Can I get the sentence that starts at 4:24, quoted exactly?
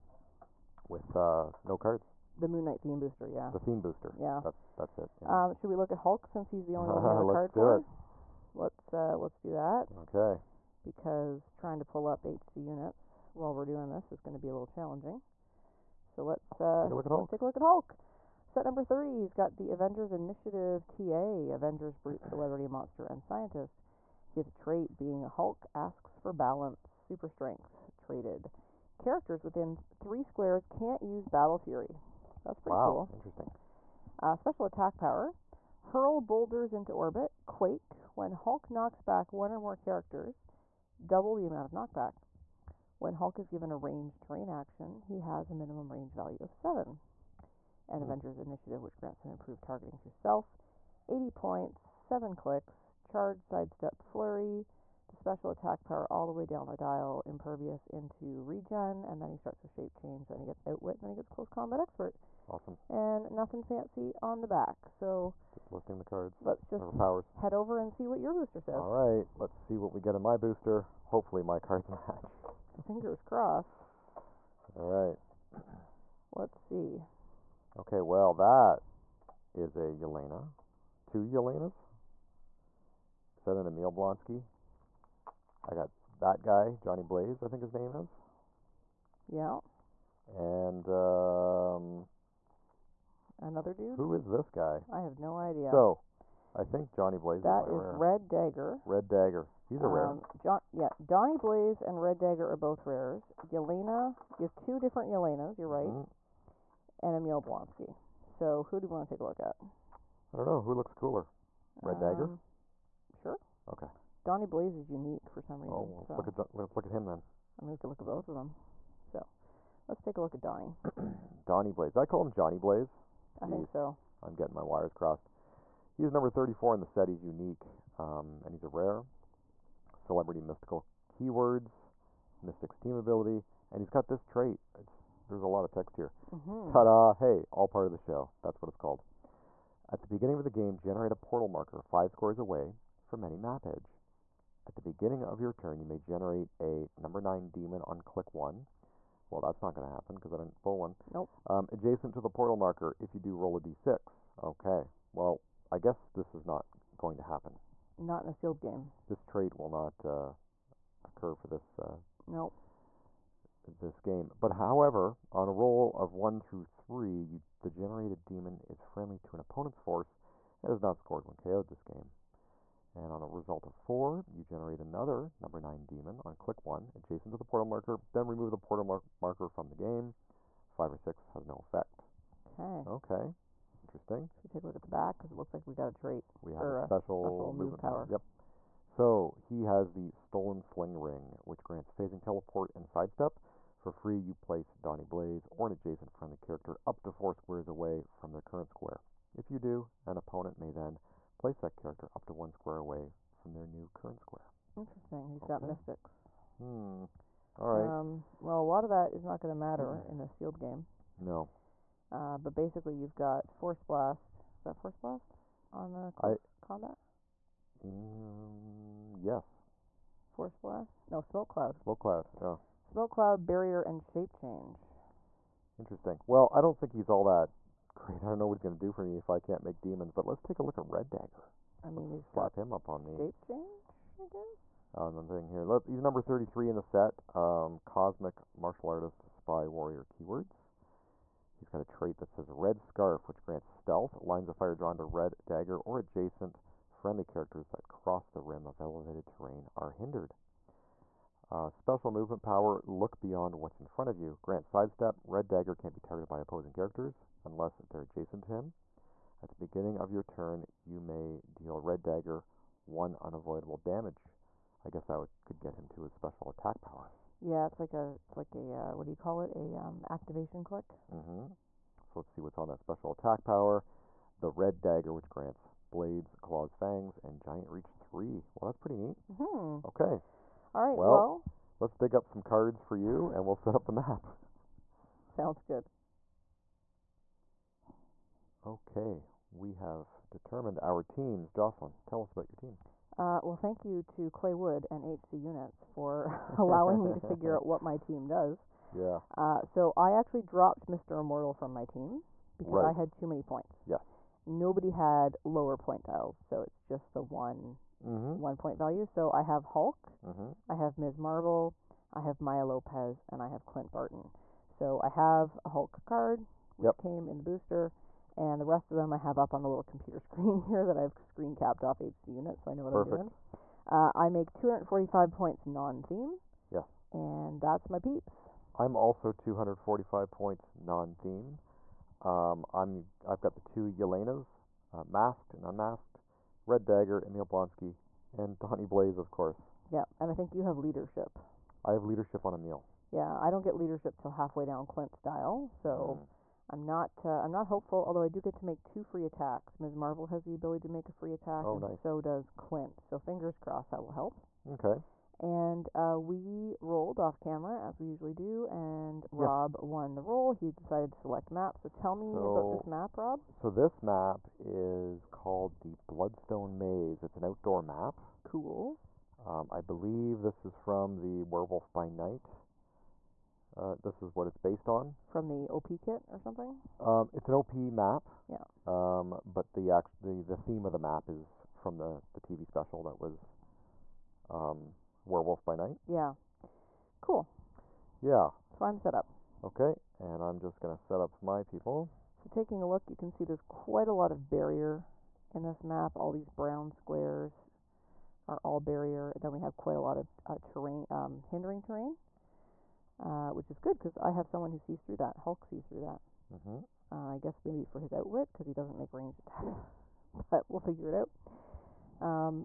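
I guess that would, could get him to his special attack power.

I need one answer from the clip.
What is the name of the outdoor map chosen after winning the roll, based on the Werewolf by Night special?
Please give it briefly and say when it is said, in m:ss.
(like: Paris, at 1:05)
Bloodstone Maze, at 6:05.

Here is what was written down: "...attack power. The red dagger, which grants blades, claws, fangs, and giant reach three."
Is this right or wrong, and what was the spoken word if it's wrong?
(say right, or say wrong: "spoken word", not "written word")
right.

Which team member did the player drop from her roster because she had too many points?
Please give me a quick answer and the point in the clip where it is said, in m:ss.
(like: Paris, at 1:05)
Mr. Immortal, at 5:00.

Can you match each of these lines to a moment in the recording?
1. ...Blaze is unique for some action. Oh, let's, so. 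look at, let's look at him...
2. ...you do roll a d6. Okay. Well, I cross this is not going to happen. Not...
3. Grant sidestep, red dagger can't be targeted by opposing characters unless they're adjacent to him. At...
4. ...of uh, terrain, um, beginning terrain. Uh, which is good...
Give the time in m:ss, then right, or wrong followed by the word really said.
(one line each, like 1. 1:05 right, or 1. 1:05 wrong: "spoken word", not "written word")
1. 1:54 wrong: "reason", not "action"
2. 2:33 wrong: "guess", not "cross"
3. 4:14 right
4. 6:40 wrong: "hindering", not "beginning".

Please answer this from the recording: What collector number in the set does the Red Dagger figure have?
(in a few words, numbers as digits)
33.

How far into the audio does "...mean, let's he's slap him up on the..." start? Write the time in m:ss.
3:51.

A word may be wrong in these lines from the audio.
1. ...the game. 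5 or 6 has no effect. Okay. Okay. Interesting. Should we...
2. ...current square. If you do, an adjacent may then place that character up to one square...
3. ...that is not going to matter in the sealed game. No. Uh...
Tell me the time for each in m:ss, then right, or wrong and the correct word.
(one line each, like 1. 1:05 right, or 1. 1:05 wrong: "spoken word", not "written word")
1. 2:59 right
2. 3:18 wrong: "opponent", not "adjacent"
3. 3:28 right.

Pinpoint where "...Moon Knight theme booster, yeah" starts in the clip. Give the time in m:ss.
0:02.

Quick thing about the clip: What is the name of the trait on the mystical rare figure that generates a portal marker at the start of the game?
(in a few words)
All Part of the Show.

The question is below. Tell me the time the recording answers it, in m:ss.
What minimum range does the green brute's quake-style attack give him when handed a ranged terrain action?
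0:45.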